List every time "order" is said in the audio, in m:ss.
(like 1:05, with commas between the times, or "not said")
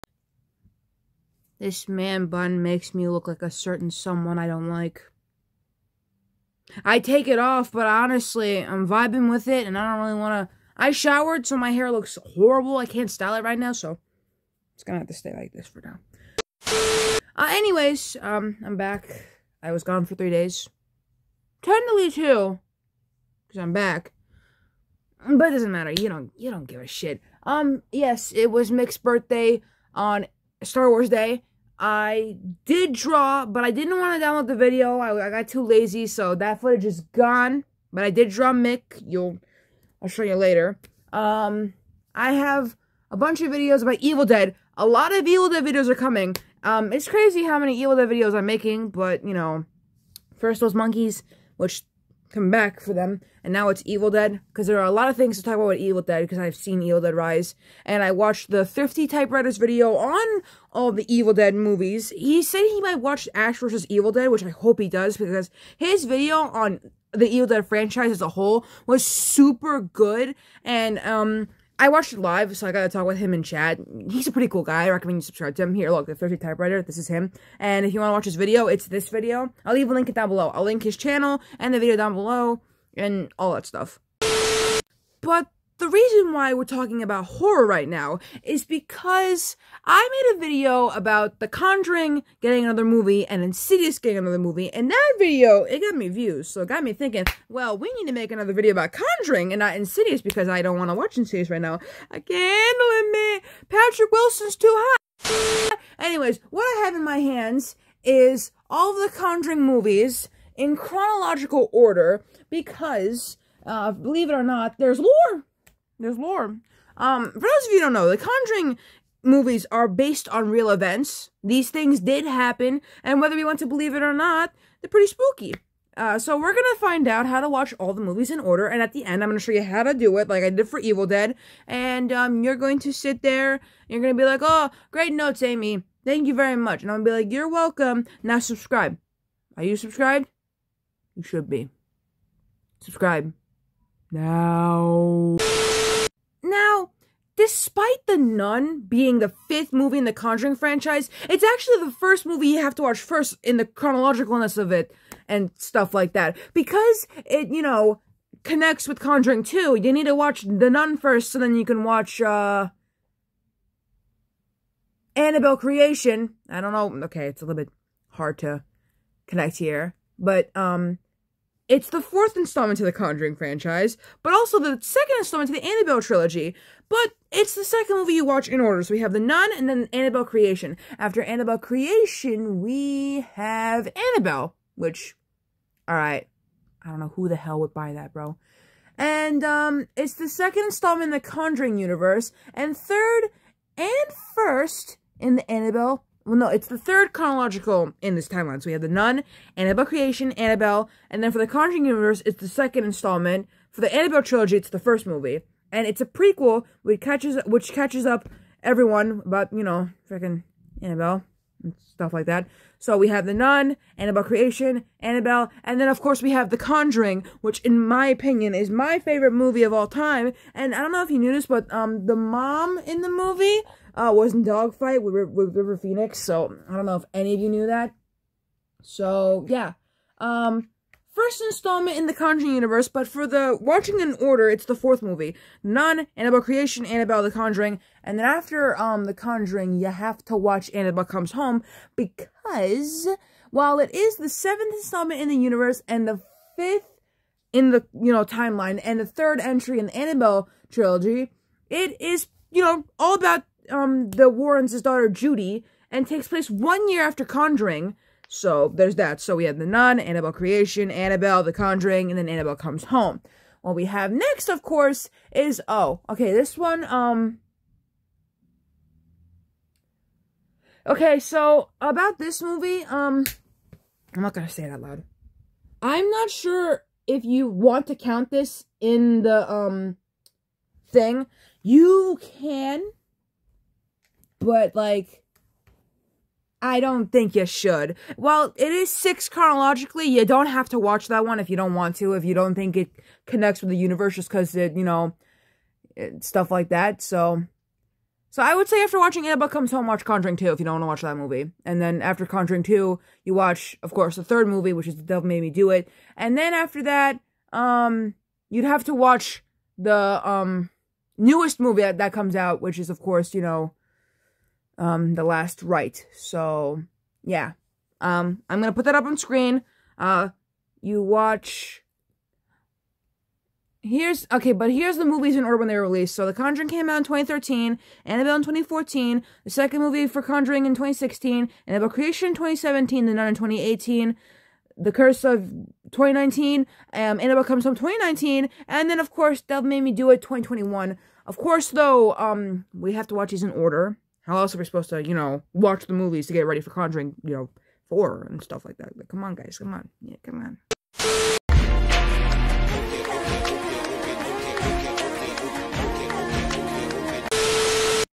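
1:51, 2:08, 2:58, 3:54, 5:25, 5:43.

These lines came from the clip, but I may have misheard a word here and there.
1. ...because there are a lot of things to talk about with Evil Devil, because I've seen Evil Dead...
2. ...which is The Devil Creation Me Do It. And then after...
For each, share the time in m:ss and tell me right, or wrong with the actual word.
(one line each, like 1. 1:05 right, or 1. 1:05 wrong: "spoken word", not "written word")
1. 0:54 wrong: "Dead", not "Devil"
2. 5:04 wrong: "Made", not "Creation".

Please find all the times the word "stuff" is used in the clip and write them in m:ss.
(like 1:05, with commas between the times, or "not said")
1:23, 2:35, 3:31, 4:56, 5:48.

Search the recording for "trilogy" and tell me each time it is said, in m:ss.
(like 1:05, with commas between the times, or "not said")
2:56, 3:24, 4:10.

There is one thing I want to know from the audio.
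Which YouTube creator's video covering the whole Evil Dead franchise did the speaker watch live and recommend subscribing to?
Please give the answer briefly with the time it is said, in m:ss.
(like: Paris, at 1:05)
The Thrifty Typewriter, at 1:16.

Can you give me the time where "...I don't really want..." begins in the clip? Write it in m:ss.
0:09.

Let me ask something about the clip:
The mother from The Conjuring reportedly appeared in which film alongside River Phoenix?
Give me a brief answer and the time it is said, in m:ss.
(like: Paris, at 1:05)
Dogfight, at 3:44.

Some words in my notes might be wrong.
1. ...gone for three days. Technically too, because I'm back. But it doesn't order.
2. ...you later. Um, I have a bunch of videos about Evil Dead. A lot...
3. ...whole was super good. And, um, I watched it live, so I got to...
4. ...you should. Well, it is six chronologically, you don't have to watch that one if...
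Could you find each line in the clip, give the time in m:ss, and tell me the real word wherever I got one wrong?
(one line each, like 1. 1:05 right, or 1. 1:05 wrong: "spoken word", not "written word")
1. 0:19 wrong: "matter", not "order"
2. 0:40 right
3. 1:08 right
4. 4:47 right.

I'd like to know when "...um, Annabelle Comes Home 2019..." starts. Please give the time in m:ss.
5:36.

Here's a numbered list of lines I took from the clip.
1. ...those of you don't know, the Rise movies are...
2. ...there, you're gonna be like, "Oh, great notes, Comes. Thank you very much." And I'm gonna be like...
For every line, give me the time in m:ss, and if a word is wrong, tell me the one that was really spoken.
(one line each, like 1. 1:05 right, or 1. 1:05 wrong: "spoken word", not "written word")
1. 1:57 wrong: "Conjuring", not "Rise"
2. 2:13 wrong: "Amy", not "Comes".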